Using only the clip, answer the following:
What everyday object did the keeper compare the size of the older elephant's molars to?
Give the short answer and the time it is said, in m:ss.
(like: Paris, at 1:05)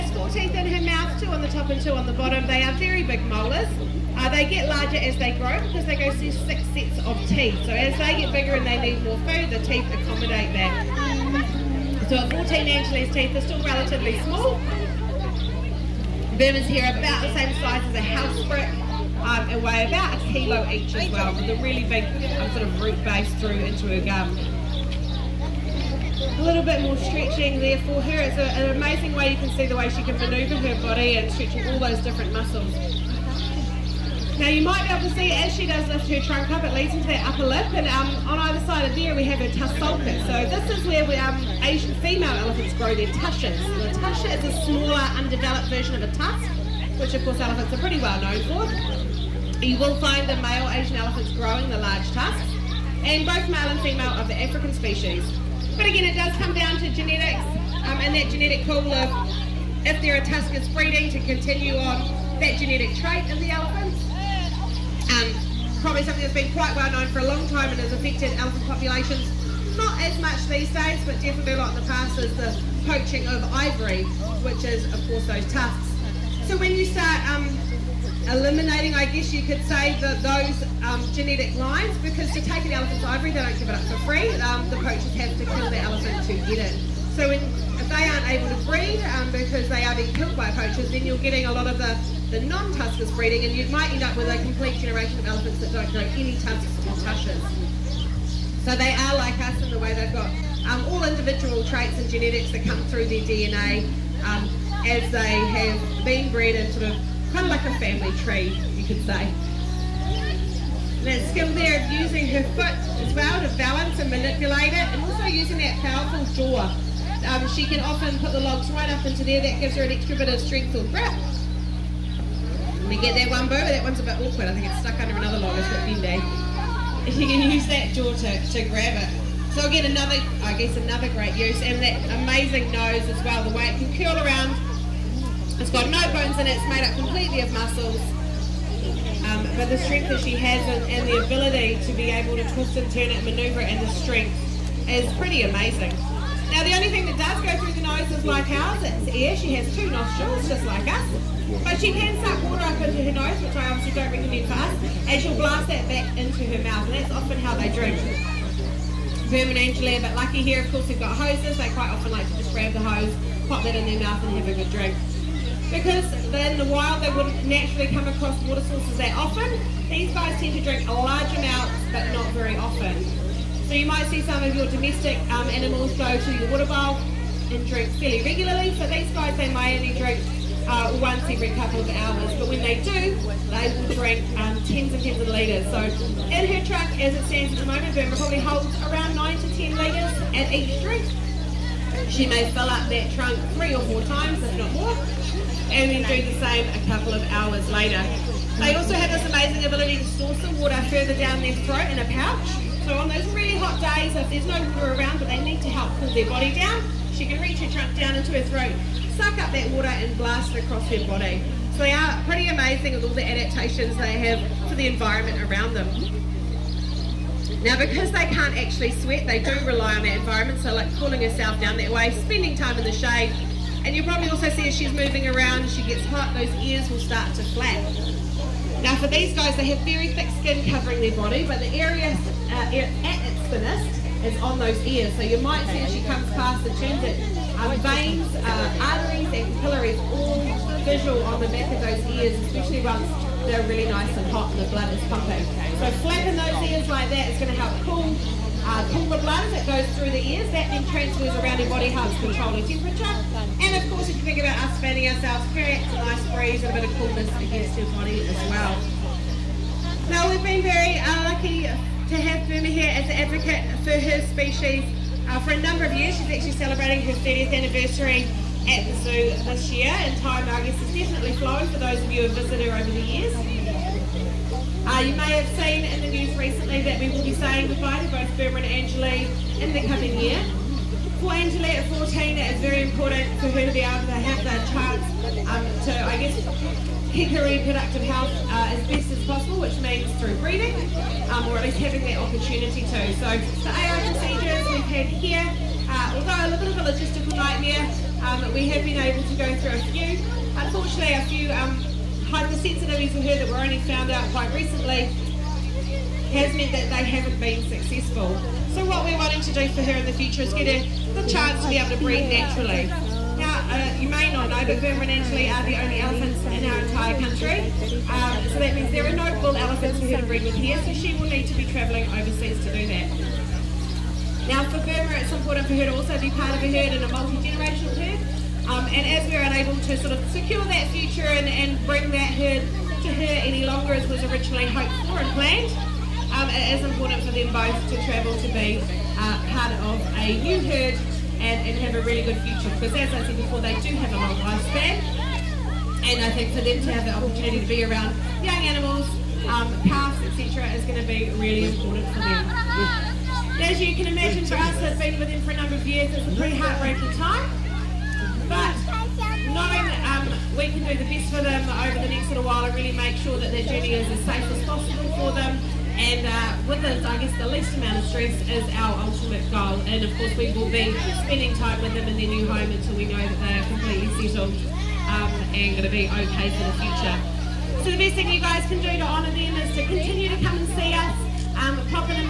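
A house brick, at 0:17.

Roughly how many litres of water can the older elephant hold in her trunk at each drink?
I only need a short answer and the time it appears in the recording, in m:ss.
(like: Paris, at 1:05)
9 to 10 litres, at 3:09.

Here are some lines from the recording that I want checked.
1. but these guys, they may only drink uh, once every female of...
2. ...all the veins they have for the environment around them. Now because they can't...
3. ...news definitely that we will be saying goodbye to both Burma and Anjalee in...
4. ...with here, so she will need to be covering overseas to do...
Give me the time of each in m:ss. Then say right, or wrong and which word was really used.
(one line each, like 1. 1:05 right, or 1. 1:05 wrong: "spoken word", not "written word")
1. 2:58 wrong: "couple", not "female"
2. 3:33 wrong: "adaptations", not "veins"
3. 4:36 wrong: "recently", not "definitely"
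4. 5:20 wrong: "travelling", not "covering".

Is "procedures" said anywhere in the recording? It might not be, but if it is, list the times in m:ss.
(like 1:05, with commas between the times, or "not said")
4:54.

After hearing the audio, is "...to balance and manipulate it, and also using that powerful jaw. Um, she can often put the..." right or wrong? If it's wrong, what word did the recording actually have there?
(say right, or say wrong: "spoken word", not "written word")
right.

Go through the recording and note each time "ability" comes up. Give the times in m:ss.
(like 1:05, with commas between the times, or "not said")
2:21, 3:19.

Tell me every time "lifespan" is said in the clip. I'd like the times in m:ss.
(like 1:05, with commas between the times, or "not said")
5:44.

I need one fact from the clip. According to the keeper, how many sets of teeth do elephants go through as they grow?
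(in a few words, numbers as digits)
6.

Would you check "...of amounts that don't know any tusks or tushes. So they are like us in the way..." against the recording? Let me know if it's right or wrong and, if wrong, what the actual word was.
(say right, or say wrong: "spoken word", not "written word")
wrong: "elephants", not "amounts".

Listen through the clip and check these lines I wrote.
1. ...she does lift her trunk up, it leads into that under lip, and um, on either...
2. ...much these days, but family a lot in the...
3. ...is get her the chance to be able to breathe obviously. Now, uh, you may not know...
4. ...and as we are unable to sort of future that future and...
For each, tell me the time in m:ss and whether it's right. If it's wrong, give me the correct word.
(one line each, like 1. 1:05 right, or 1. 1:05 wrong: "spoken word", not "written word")
1. 0:35 wrong: "upper", not "under"
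2. 1:10 wrong: "definitely", not "family"
3. 5:10 wrong: "naturally", not "obviously"
4. 5:28 wrong: "secure", not "future".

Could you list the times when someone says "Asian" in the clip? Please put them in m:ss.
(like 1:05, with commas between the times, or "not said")
0:41, 0:50.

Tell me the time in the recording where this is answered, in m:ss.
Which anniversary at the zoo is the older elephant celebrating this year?
4:27.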